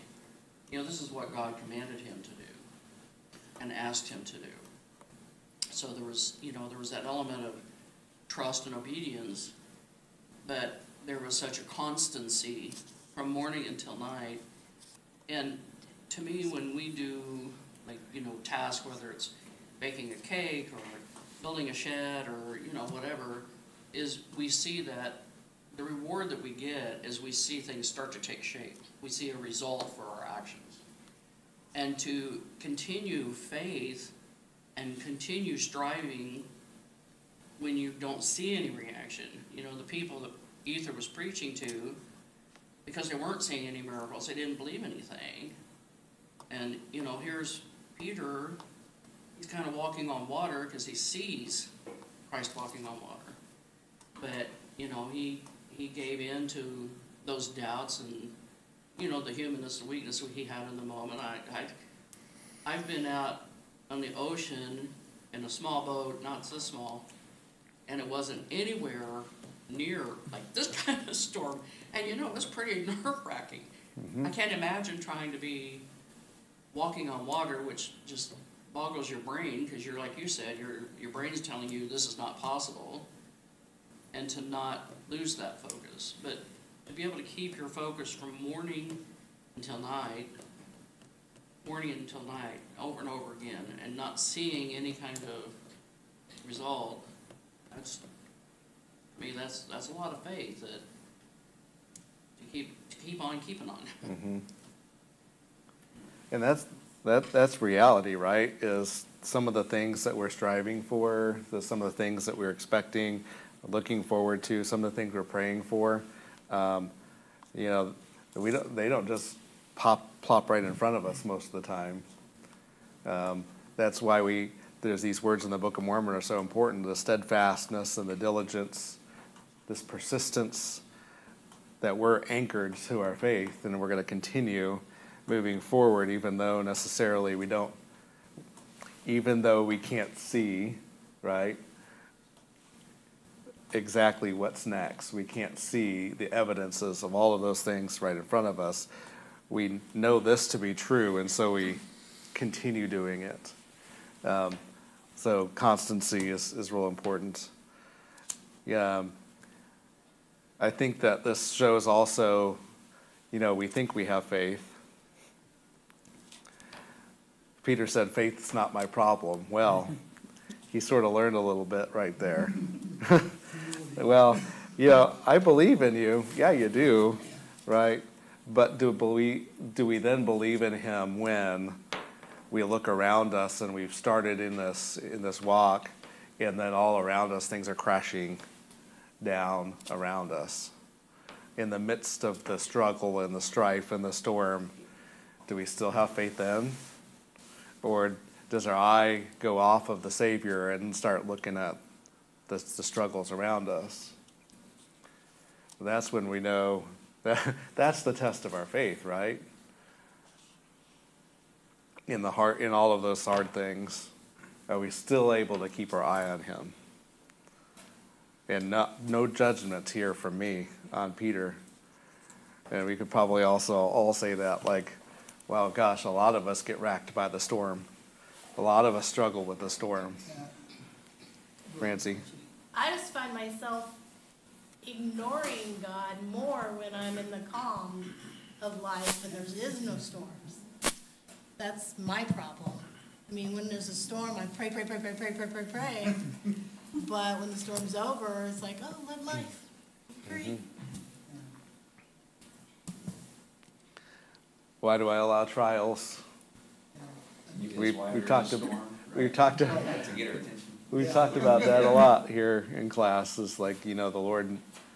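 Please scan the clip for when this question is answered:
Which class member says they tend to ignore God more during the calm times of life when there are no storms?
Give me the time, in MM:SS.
03:51.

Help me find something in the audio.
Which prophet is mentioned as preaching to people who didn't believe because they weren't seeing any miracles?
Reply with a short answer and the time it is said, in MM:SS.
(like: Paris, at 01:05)
Ether, at 00:40.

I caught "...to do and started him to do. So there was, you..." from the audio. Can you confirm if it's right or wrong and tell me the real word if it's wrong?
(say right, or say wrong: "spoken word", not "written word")
wrong: "asked", not "started".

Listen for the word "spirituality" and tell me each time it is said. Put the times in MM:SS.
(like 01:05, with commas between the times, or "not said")
not said.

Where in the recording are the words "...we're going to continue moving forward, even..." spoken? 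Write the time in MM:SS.
02:13.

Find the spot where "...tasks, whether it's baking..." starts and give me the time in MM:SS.
00:18.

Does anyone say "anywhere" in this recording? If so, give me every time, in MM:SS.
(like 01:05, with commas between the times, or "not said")
01:08.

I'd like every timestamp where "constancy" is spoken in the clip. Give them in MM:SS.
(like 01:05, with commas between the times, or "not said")
00:11, 02:35.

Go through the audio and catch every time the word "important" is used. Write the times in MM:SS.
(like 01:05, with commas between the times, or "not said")
02:06, 02:36.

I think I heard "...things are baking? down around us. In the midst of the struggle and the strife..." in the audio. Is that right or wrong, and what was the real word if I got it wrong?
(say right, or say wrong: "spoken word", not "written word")
wrong: "crashing", not "baking".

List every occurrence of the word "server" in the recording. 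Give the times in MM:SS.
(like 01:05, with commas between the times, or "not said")
not said.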